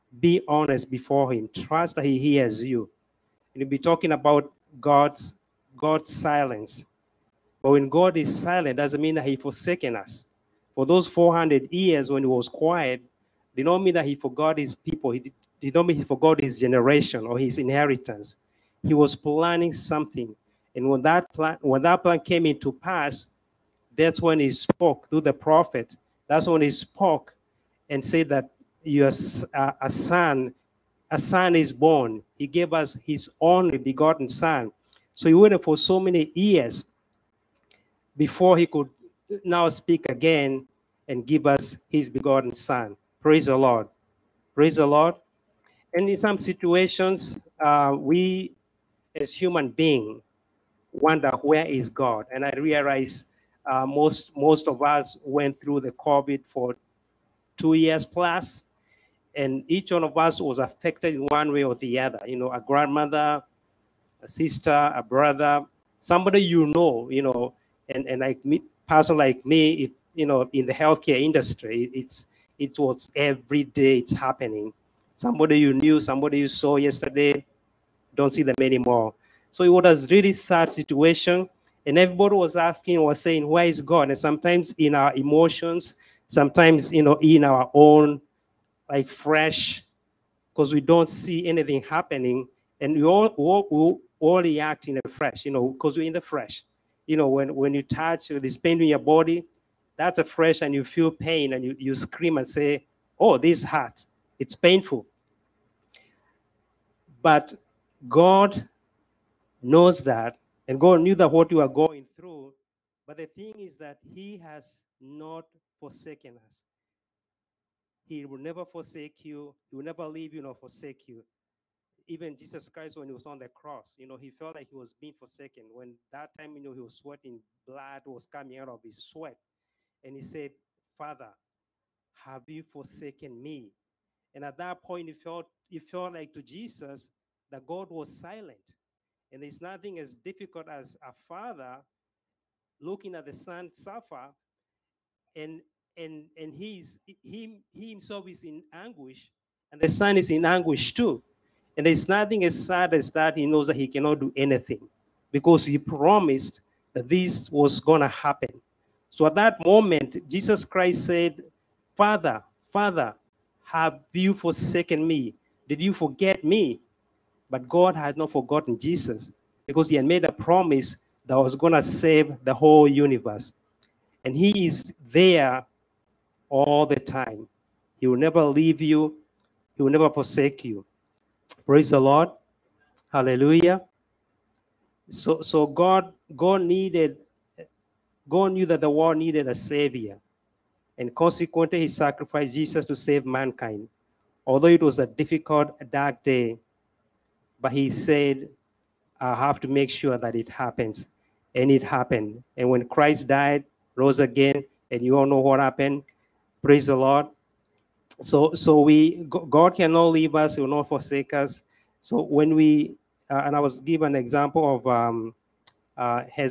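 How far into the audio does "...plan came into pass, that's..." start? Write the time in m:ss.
0:22.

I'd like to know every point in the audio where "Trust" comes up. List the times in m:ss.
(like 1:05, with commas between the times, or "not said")
0:01.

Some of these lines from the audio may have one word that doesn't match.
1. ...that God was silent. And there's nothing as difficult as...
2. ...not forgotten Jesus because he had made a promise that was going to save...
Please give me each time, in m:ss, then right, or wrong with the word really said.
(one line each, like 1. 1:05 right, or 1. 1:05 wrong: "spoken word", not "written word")
1. 2:17 right
2. 2:48 right.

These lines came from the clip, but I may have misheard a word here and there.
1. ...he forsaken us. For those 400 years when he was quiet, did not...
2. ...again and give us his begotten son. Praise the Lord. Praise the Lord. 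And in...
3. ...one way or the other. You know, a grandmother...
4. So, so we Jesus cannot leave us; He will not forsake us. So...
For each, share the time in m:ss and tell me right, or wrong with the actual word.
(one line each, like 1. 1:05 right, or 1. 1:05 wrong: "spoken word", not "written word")
1. 0:09 right
2. 0:40 right
3. 1:01 right
4. 3:28 wrong: "God", not "Jesus".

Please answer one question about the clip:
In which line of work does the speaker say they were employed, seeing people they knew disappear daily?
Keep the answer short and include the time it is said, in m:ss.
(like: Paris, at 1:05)
healthcare industry, at 1:10.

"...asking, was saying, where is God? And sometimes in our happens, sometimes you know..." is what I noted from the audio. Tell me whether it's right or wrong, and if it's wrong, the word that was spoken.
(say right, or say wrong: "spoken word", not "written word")
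wrong: "emotions", not "happens".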